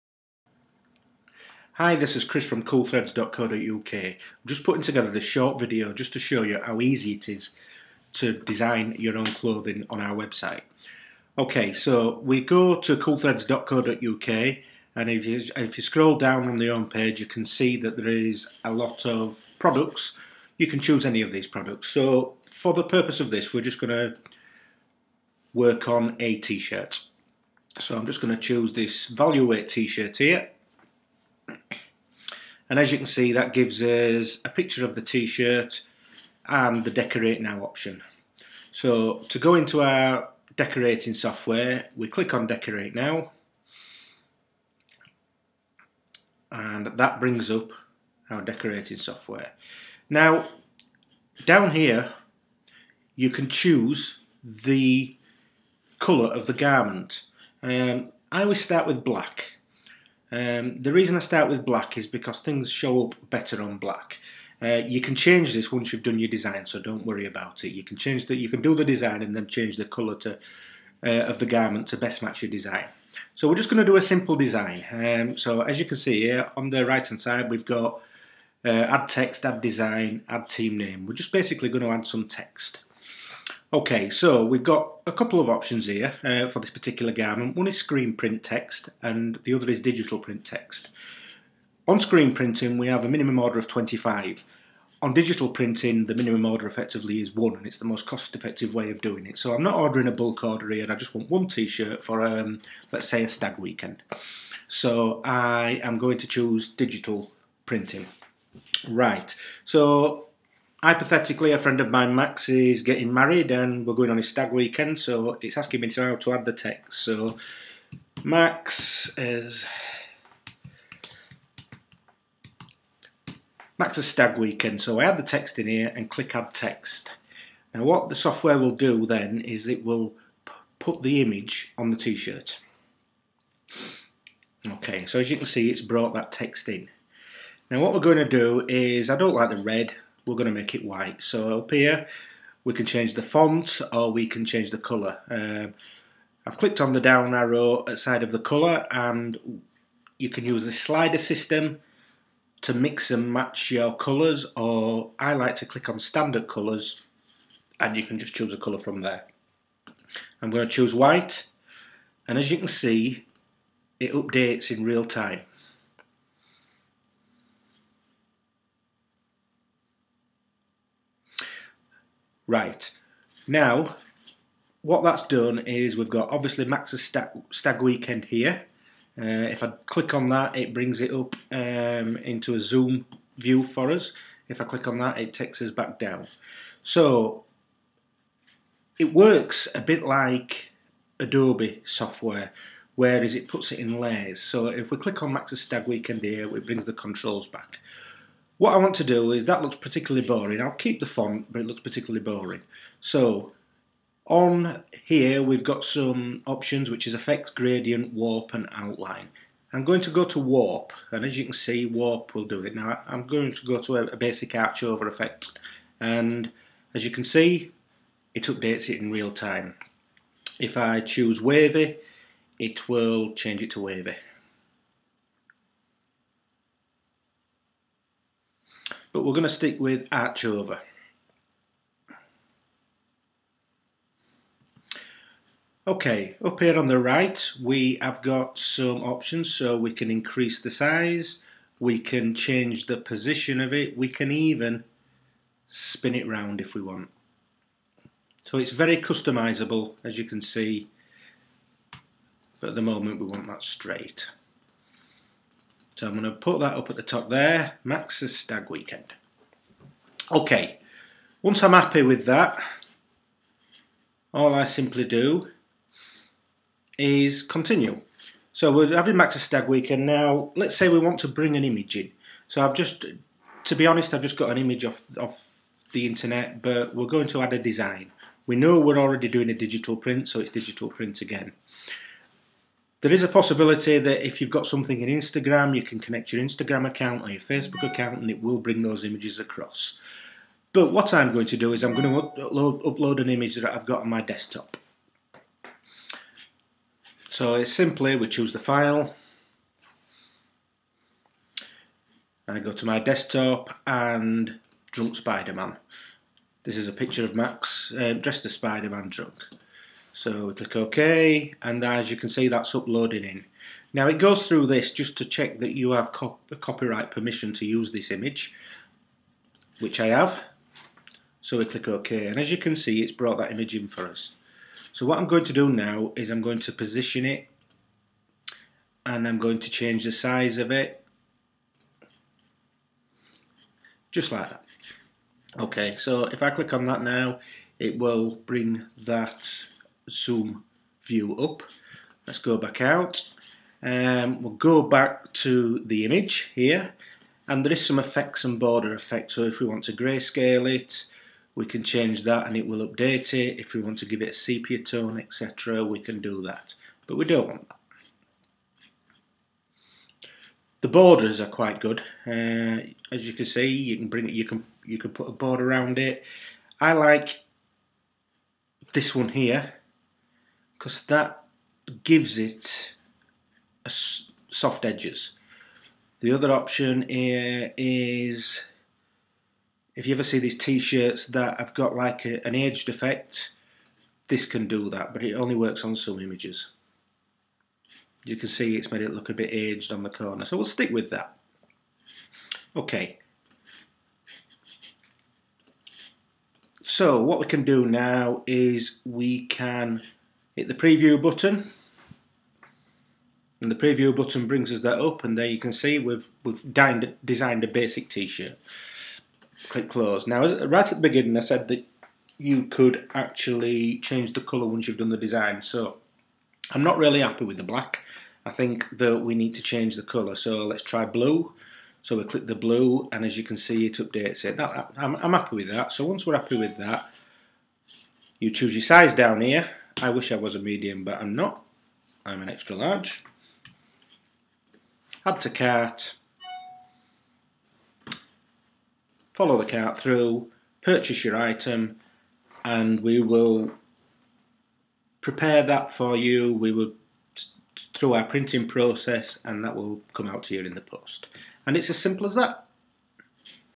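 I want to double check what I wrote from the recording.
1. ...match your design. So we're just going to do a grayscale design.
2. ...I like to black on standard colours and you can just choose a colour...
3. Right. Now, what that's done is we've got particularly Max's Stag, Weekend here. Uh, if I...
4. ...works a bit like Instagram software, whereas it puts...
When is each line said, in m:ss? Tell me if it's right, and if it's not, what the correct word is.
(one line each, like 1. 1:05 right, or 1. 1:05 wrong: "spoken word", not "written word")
1. 1:12 wrong: "simple", not "grayscale"
2. 2:35 wrong: "click", not "black"
3. 2:52 wrong: "obviously", not "particularly"
4. 3:09 wrong: "Adobe", not "Instagram".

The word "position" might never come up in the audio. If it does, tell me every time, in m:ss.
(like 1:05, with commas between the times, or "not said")
4:02, 5:26.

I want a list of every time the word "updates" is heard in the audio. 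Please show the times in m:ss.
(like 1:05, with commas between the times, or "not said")
2:44, 3:38, 5:52, 7:03.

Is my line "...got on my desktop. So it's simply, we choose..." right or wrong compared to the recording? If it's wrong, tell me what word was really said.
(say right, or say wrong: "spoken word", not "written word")
right.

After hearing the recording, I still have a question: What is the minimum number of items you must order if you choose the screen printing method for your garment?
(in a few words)
25.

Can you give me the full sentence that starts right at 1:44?
So I am going to choose digital printing.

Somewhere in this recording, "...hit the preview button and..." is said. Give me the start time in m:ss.
6:40.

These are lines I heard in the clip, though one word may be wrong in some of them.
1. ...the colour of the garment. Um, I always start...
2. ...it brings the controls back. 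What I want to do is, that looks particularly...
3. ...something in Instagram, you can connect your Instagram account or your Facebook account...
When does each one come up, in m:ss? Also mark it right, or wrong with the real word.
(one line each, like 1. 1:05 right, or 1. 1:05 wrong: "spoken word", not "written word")
1. 0:54 right
2. 3:16 right
3. 4:44 right.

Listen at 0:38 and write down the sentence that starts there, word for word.
So to go into our decorating software, we click on decorate now.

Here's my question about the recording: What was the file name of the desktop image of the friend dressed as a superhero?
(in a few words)
Drunk Spider-Man.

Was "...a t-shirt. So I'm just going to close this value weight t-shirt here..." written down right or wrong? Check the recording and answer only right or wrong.
wrong.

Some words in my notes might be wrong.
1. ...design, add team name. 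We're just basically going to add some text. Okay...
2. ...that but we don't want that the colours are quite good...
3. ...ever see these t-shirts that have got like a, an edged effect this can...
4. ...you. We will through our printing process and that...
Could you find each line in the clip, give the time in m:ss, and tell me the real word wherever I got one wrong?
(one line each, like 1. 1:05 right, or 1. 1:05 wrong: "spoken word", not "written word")
1. 1:19 right
2. 5:56 wrong: "borders", not "colours"
3. 6:20 right
4. 7:26 right.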